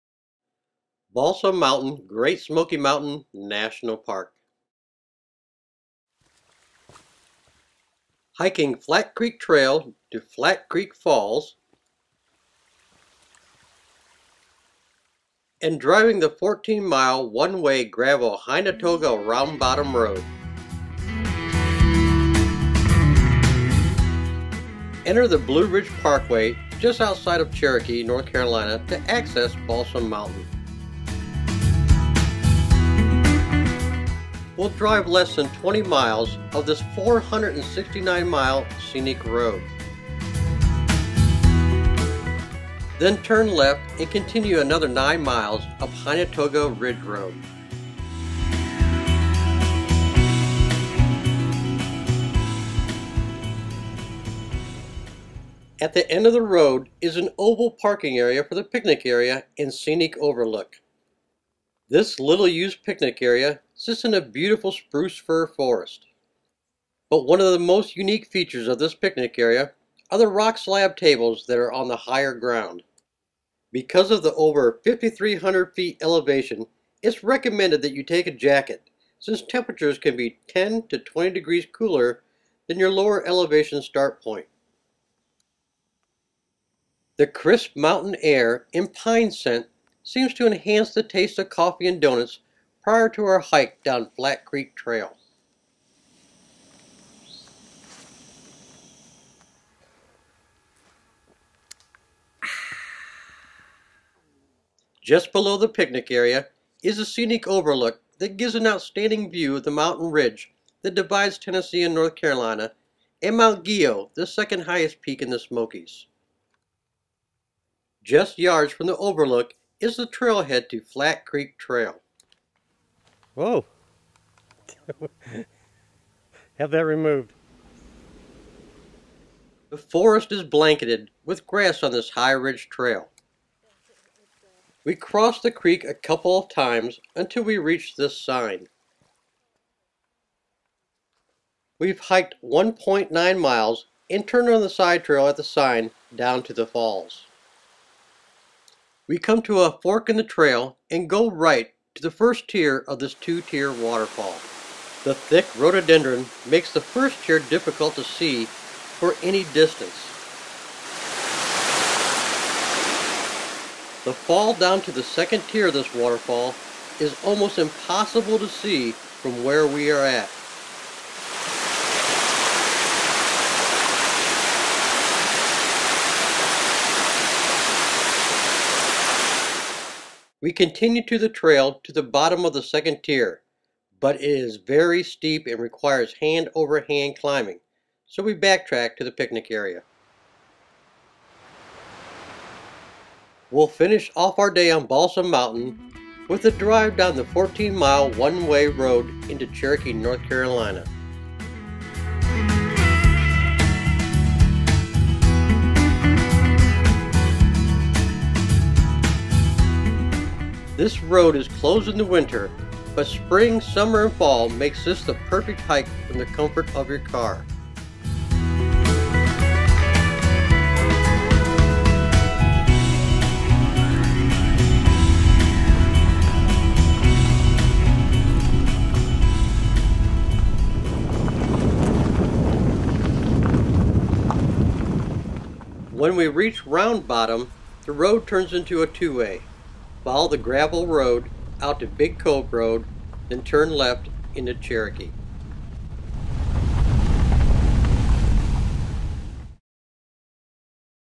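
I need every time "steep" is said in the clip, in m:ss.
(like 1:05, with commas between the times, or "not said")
3:05.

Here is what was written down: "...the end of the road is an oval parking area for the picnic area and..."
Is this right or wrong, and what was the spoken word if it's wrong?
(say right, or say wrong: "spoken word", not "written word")
right.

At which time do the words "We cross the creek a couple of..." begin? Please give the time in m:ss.
2:14.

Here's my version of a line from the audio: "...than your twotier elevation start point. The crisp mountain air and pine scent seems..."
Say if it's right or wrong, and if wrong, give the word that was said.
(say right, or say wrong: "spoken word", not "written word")
wrong: "lower", not "twotier".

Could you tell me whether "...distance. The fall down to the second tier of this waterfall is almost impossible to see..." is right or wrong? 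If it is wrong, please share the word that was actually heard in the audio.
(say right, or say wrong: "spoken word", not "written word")
right.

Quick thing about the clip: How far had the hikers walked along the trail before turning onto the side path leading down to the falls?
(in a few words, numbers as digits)
1.9 miles.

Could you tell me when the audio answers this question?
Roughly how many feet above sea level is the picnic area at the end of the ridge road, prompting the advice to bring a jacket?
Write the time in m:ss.
1:14.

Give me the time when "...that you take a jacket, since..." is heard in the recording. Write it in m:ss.
1:17.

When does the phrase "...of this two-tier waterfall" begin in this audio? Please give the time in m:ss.
2:32.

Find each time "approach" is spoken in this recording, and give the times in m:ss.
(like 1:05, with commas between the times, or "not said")
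not said.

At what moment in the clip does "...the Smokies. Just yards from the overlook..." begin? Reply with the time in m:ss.
1:55.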